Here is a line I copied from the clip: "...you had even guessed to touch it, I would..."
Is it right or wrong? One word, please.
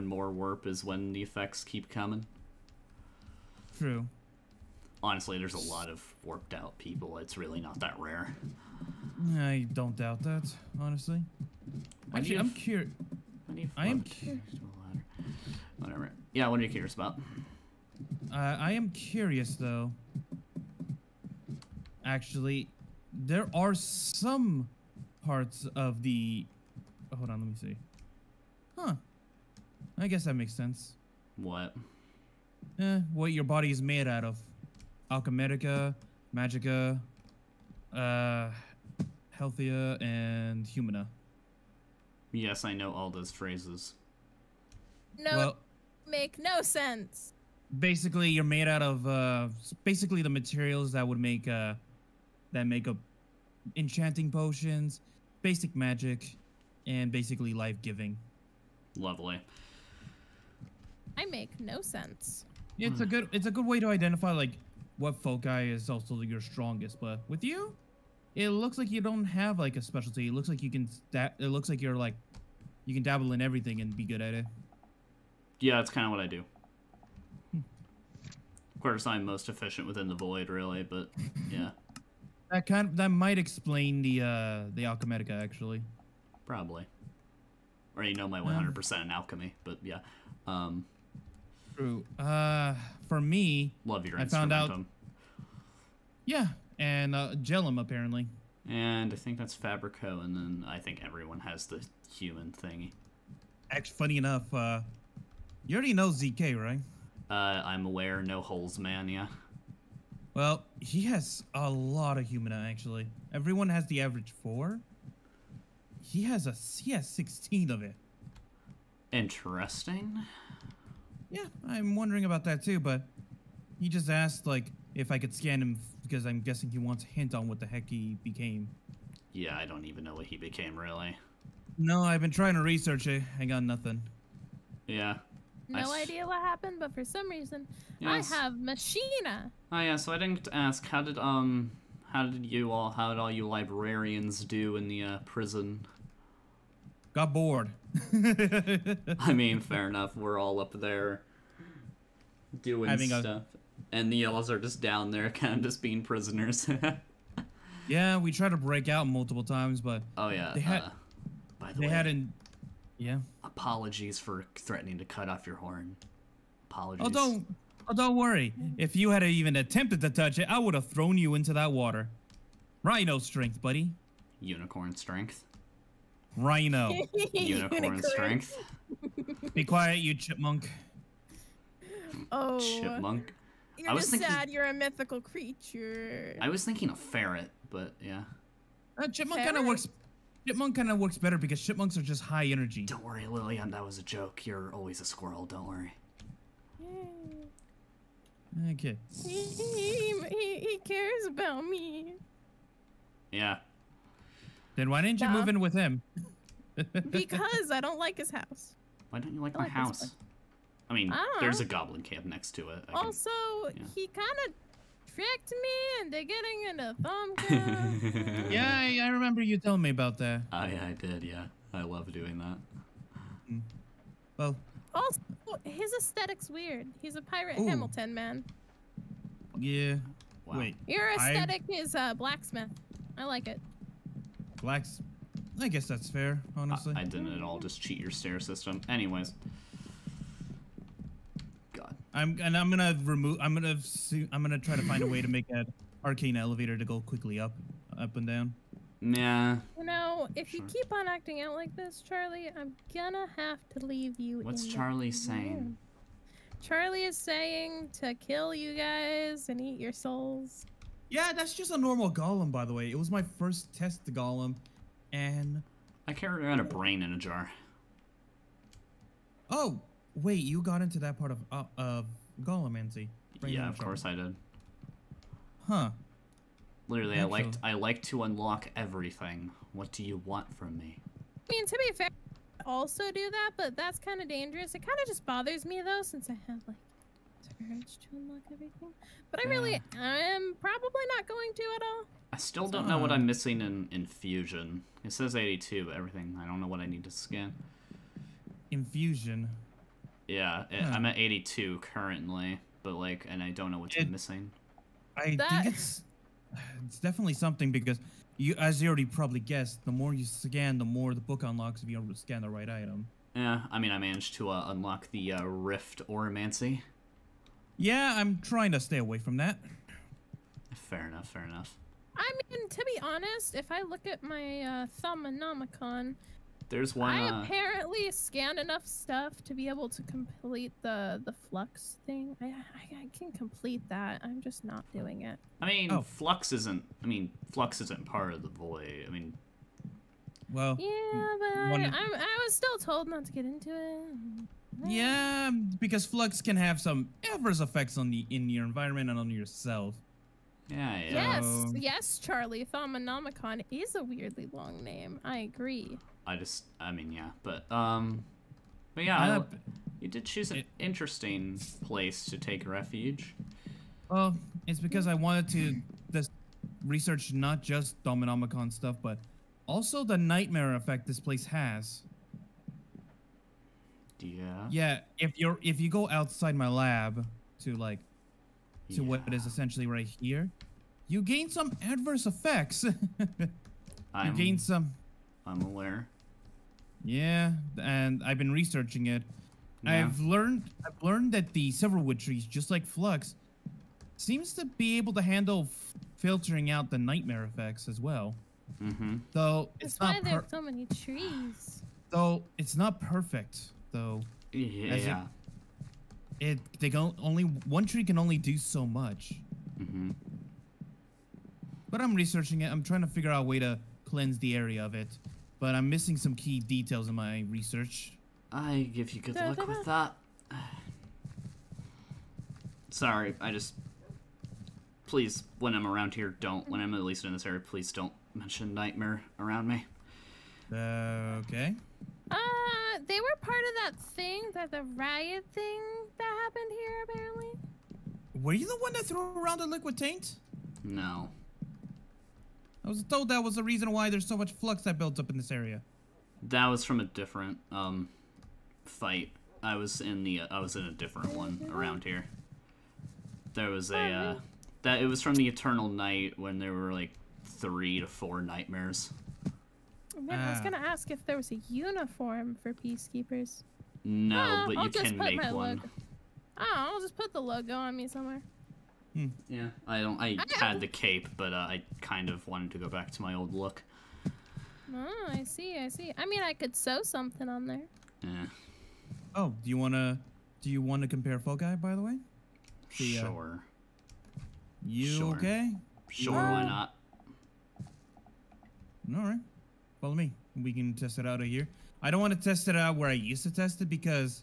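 wrong.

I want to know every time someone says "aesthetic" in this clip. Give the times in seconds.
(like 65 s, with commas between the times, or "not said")
225 s, 231 s.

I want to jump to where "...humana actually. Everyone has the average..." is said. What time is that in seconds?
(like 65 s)
112 s.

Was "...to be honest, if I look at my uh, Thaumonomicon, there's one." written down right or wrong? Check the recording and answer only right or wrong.
right.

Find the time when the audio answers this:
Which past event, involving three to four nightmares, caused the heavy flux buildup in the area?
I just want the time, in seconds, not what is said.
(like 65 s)
455 s.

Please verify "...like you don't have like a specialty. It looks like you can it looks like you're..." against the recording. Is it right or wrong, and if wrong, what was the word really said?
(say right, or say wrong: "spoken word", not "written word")
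right.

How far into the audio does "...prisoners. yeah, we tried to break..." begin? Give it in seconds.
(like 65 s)
156 s.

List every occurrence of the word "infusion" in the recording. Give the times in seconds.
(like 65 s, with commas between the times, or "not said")
293 s, 298 s.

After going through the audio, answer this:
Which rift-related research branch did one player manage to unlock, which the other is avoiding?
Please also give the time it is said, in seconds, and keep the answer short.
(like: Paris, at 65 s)
Rift Auromancy, at 315 s.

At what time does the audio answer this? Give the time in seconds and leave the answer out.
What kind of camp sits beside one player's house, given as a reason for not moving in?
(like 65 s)
211 s.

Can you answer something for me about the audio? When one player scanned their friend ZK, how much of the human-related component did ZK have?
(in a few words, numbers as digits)
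16.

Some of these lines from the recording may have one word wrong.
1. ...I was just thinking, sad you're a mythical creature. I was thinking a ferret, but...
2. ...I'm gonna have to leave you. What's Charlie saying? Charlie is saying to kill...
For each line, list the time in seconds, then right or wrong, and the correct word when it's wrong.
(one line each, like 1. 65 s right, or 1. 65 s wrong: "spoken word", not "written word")
1. 183 s right
2. 252 s right.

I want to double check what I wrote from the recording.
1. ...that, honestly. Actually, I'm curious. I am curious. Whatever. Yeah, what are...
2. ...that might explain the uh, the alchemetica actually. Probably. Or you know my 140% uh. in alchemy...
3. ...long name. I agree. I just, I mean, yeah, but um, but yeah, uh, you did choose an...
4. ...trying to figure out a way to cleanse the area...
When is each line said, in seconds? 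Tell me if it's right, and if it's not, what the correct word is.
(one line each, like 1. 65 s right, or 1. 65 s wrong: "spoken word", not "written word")
1. 10 s right
2. 82 s wrong: "100", not "140"
3. 354 s right
4. 412 s right.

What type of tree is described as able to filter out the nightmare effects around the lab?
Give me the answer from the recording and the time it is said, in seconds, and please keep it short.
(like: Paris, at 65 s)
silverwood, at 391 s.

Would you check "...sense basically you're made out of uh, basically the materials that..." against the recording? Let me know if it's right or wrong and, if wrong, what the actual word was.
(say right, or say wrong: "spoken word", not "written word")
right.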